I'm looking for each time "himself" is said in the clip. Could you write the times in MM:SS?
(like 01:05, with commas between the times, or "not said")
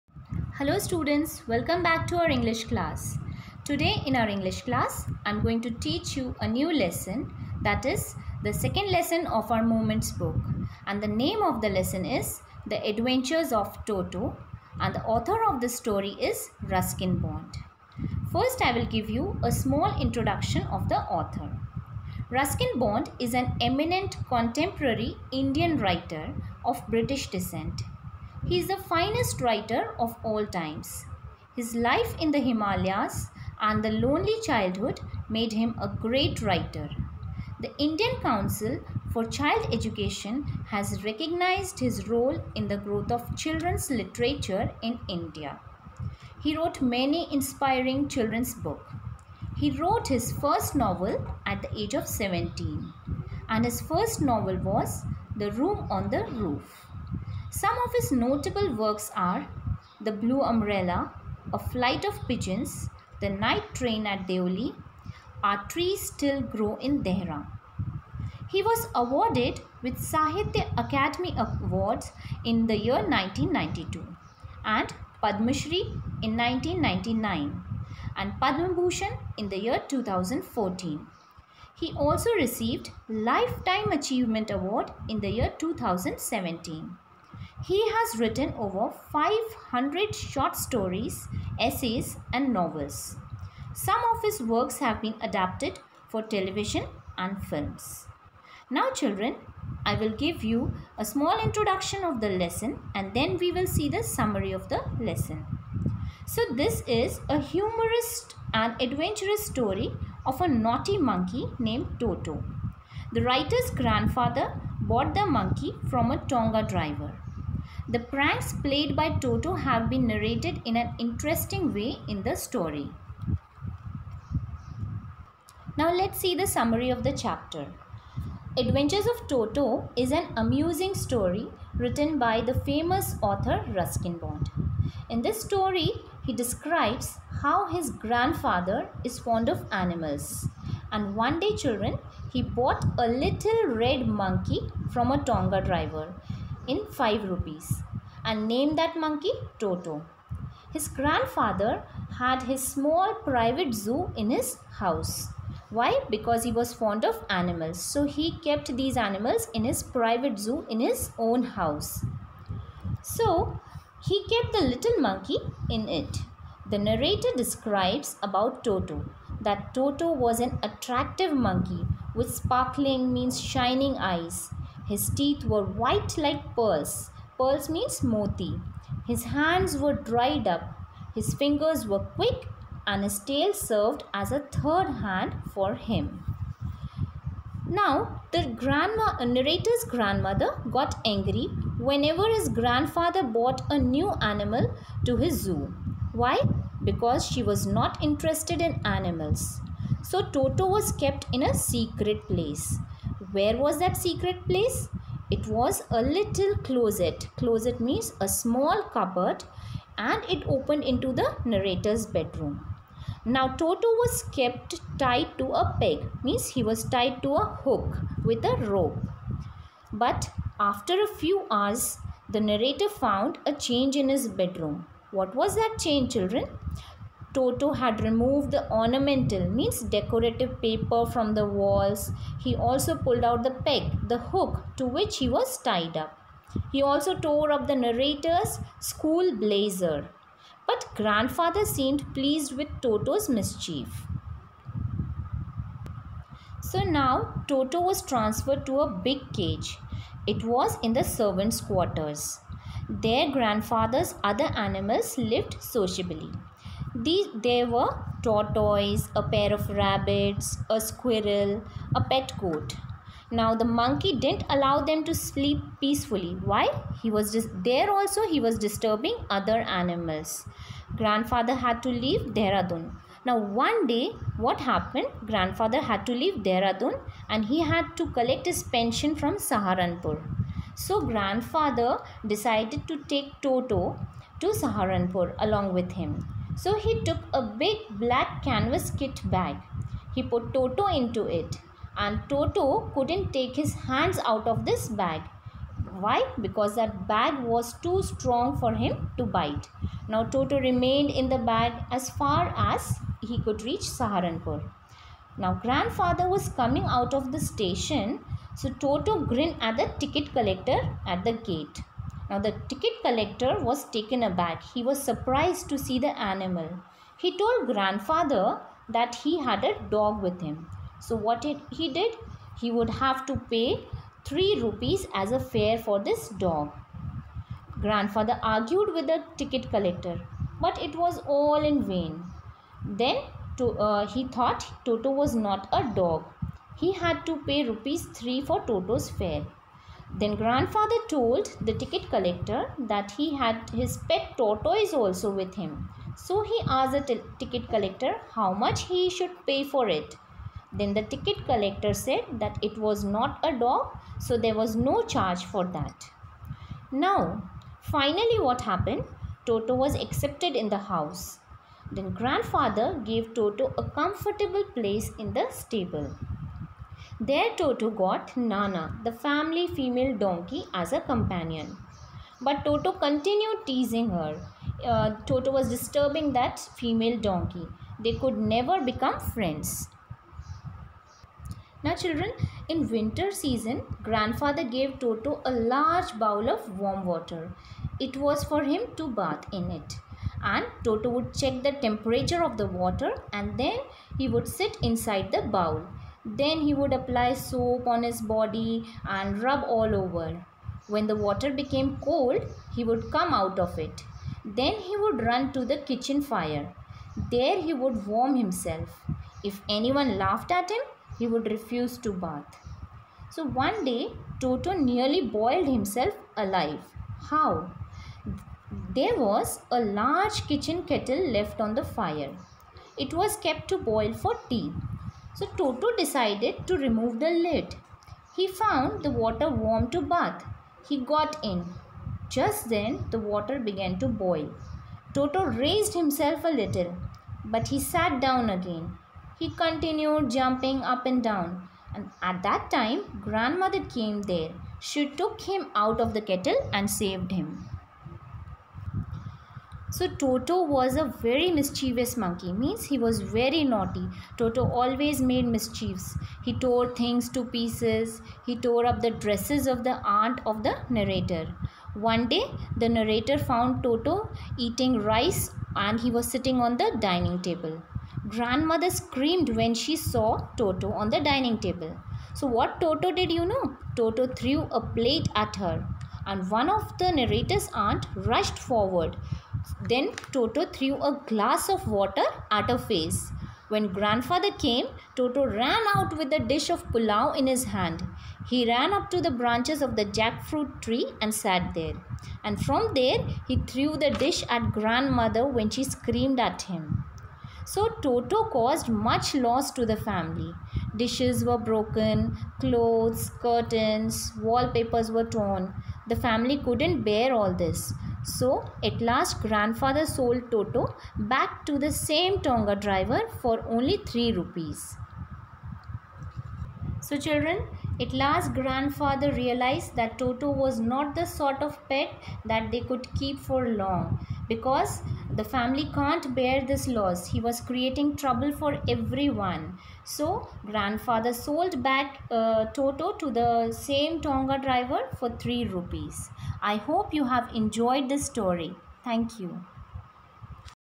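06:48, 06:55, 07:15.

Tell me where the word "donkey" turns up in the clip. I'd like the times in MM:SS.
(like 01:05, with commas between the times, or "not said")
06:10, 06:17.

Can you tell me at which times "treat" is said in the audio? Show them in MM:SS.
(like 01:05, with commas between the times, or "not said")
not said.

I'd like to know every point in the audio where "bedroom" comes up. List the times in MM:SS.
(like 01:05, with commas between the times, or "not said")
03:32, 03:44.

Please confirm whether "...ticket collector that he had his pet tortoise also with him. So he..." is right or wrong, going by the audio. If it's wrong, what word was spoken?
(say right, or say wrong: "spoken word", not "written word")
right.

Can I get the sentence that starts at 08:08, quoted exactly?
He ran up to the branches of the jackfruit tree and sat there.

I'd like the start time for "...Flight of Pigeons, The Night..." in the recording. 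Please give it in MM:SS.
01:01.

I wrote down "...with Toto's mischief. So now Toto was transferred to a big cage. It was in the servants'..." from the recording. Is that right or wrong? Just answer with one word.
right.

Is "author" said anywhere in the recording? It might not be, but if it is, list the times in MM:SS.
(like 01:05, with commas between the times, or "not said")
00:15, 00:21, 02:13.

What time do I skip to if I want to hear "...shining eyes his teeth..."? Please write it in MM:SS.
02:53.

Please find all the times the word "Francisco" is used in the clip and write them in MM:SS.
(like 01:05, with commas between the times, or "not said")
not said.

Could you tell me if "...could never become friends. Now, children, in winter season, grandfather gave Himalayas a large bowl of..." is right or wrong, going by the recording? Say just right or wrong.
wrong.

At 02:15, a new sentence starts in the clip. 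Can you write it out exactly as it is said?
In this story, he describes how his grandfather is fond of animals.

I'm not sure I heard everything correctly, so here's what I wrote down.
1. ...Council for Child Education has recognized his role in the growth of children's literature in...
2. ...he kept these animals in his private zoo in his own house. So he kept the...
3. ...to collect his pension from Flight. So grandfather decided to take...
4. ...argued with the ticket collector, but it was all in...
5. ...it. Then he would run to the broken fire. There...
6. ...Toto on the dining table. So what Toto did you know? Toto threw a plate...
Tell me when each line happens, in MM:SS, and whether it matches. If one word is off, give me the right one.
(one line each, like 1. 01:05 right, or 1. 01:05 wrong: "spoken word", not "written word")
1. 00:38 right
2. 02:38 right
3. 04:37 wrong: "Saharanpur", not "Flight"
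4. 05:28 right
5. 06:43 wrong: "kitchen", not "broken"
6. 07:50 right.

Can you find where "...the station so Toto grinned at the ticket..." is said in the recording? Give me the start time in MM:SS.
05:07.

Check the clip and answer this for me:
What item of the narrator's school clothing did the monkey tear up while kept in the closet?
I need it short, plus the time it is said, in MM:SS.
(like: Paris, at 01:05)
school blazer, at 03:58.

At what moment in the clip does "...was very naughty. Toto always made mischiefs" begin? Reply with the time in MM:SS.
07:32.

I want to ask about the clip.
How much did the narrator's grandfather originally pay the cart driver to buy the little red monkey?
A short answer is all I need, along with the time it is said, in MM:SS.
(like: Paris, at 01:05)
5 rupees, at 02:27.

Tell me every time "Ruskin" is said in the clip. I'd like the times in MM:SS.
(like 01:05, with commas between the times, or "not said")
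00:16, 00:22, 02:13.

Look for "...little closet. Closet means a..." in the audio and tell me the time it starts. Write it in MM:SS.
03:26.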